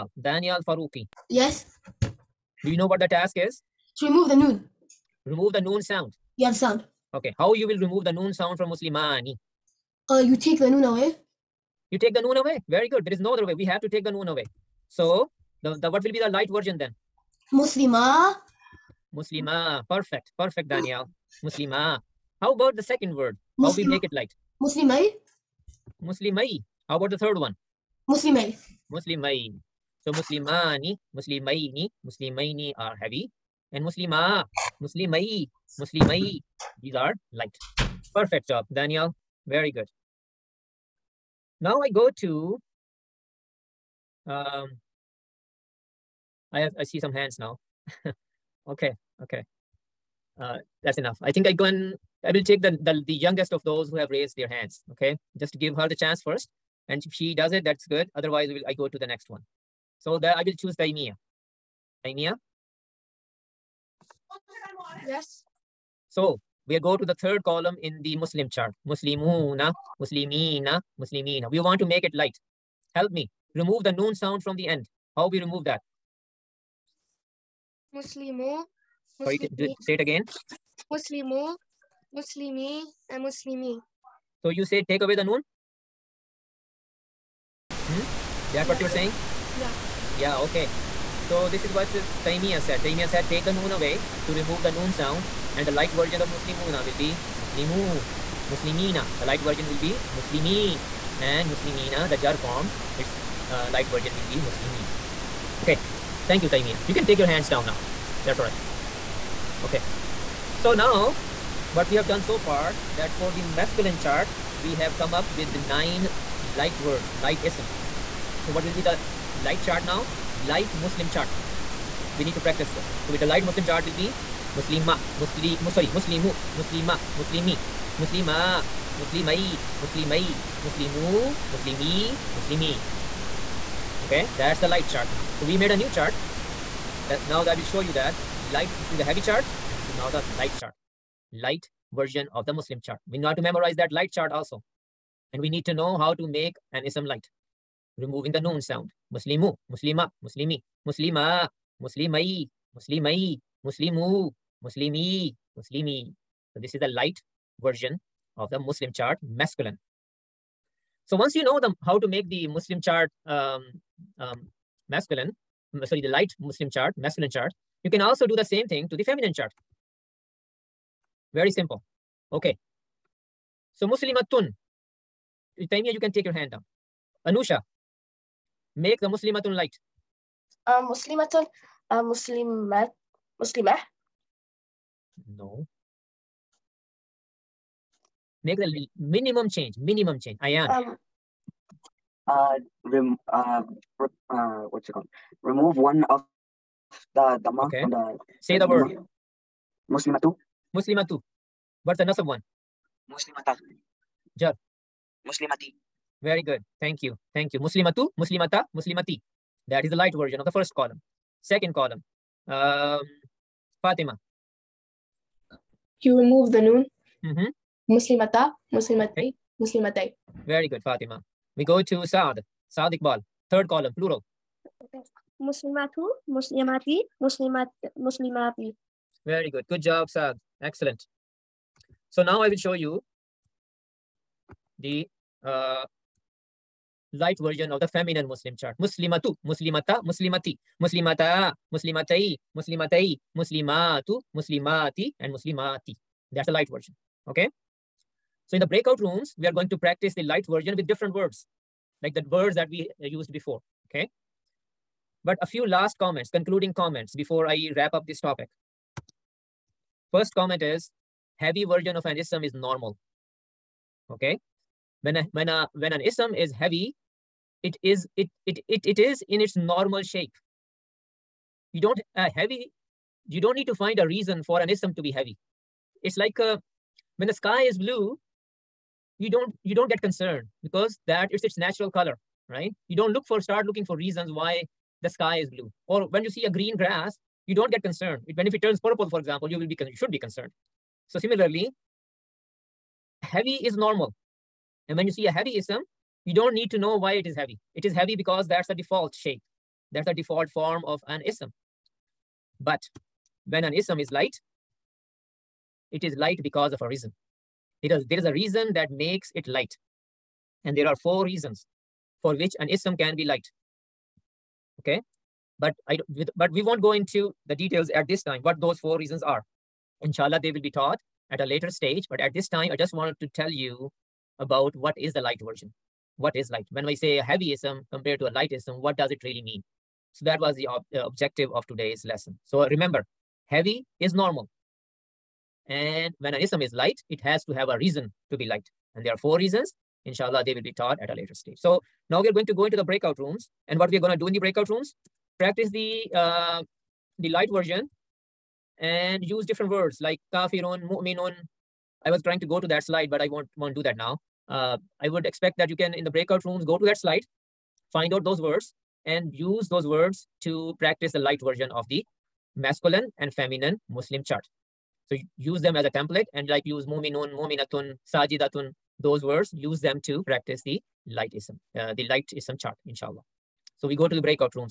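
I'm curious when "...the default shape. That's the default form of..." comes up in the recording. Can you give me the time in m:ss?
4:58.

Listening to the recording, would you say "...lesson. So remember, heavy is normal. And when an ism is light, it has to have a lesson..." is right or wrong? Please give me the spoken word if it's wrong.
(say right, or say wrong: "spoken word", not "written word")
wrong: "reason", not "lesson".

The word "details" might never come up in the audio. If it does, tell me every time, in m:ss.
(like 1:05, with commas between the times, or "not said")
5:17.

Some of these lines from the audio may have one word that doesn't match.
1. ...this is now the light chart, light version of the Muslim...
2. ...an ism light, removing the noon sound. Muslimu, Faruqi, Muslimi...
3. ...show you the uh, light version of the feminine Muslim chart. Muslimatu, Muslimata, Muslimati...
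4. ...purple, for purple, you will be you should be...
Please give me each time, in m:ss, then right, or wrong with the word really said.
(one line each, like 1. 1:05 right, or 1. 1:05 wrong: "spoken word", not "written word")
1. 2:19 right
2. 2:26 wrong: "Muslima", not "Faruqi"
3. 3:52 right
4. 4:48 wrong: "example", not "purple".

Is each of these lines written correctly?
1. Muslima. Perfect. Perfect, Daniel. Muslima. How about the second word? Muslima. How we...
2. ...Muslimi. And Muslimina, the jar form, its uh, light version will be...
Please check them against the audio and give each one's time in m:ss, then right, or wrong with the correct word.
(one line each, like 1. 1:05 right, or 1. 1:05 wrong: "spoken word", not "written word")
1. 0:19 right
2. 1:40 right.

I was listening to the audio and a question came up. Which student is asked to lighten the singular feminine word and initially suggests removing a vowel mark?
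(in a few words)
Anusha.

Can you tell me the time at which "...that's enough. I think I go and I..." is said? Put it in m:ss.
0:50.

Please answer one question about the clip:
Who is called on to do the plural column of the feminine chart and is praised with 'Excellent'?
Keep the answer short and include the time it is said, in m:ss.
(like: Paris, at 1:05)
Saad Iqbal, at 3:42.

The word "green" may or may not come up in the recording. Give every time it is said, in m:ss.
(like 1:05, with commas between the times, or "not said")
4:46.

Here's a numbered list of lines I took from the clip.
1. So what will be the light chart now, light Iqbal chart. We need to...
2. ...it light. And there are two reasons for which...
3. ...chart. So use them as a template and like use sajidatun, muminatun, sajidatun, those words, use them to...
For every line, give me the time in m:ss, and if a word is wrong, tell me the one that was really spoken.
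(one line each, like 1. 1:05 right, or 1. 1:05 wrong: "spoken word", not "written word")
1. 1:58 wrong: "Muslim", not "Iqbal"
2. 5:09 wrong: "four", not "two"
3. 6:04 wrong: "muminun", not "sajidatun".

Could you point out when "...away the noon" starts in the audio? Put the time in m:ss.
1:25.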